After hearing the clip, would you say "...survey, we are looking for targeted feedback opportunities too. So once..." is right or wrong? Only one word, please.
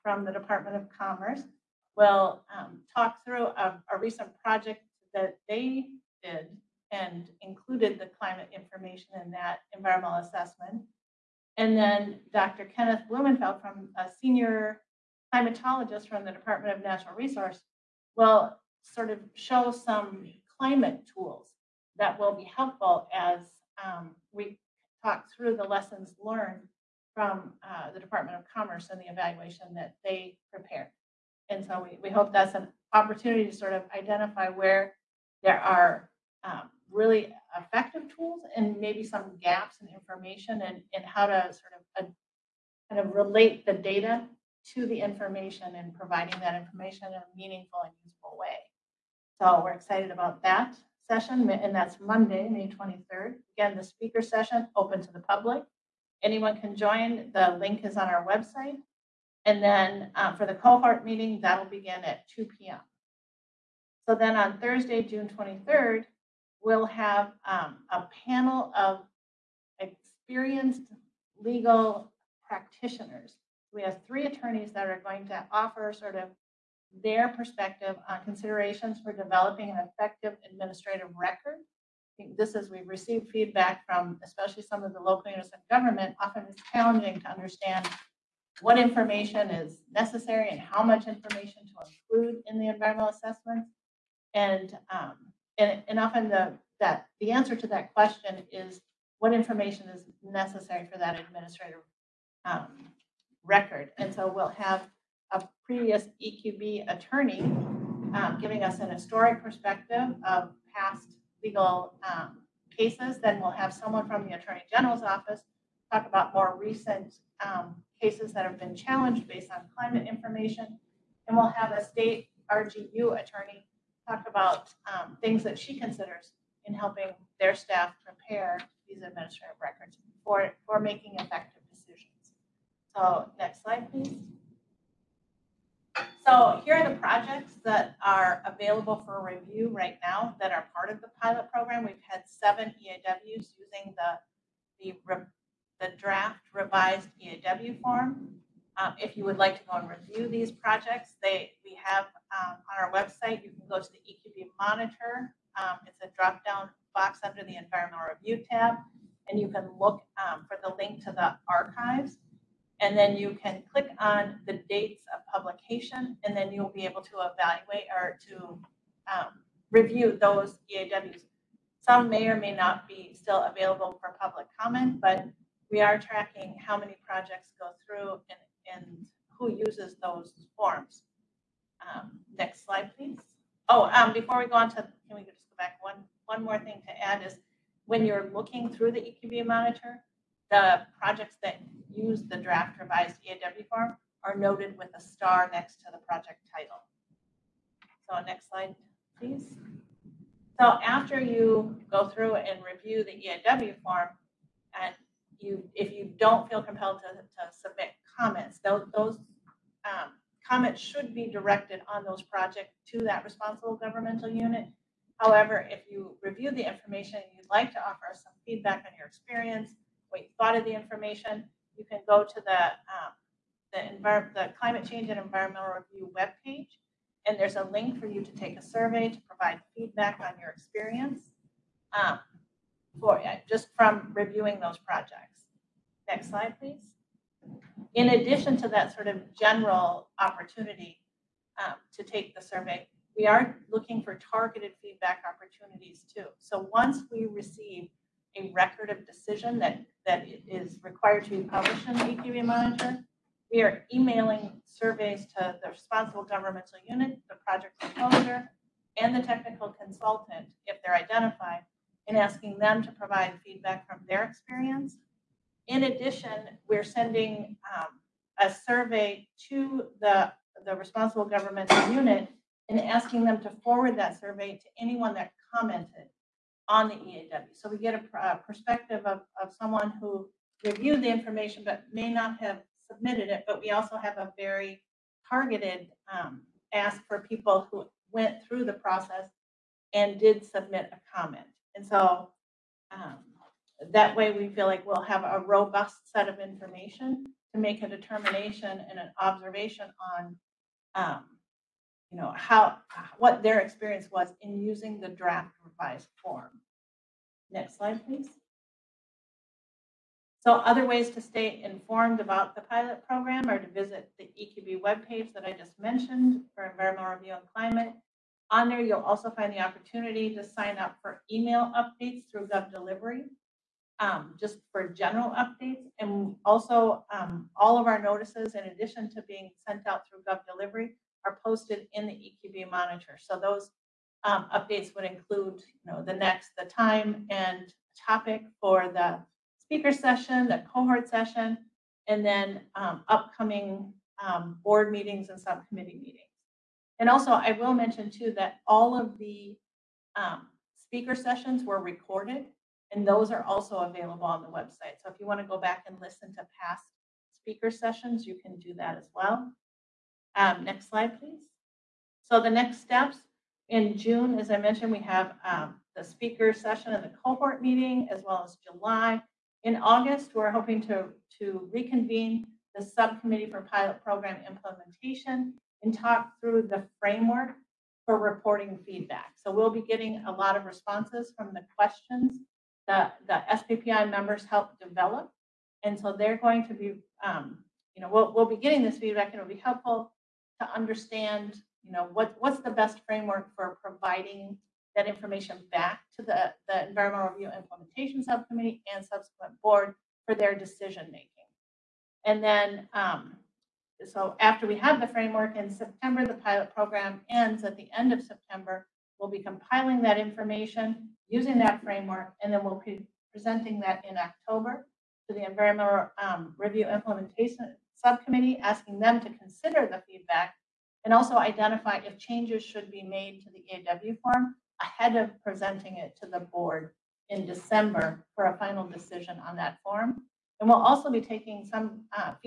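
right.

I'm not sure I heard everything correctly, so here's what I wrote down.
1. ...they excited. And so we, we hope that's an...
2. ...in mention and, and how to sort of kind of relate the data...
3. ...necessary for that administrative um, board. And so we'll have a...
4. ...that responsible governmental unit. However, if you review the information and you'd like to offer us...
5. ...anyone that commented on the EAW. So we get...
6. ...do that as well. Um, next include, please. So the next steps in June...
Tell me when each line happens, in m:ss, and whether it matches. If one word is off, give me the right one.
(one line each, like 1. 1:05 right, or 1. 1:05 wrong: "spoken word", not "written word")
1. 0:30 wrong: "prepared", not "excited"
2. 0:39 wrong: "information", not "mention"
3. 1:40 wrong: "record", not "board"
4. 3:33 right
5. 4:34 right
6. 5:58 wrong: "slide", not "include".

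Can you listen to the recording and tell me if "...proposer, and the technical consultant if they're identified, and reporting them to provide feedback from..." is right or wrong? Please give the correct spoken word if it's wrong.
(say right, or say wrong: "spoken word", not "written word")
wrong: "asking", not "reporting".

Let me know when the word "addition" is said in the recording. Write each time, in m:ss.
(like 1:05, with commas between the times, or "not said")
3:58, 4:25, 5:28.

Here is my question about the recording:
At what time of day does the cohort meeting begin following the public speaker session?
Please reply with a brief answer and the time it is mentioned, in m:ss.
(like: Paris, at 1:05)
2 p.m., at 1:02.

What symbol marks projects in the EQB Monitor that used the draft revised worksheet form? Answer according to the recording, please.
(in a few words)
A star.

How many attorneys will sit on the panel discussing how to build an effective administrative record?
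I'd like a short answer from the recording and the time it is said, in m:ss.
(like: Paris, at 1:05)
3, at 1:14.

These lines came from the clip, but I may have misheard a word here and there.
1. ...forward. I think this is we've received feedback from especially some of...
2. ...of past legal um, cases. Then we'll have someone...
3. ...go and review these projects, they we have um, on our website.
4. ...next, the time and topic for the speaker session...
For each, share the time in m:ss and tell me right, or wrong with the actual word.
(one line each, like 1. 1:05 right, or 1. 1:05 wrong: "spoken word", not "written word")
1. 1:21 wrong: "record", not "forward"
2. 1:50 right
3. 2:29 right
4. 5:36 right.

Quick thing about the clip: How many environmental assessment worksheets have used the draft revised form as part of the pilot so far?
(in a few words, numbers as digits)
7.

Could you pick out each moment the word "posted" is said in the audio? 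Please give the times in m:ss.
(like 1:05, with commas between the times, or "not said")
5:31.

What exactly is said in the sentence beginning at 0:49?
So we're excited about that session, and that's Monday, May 23rd.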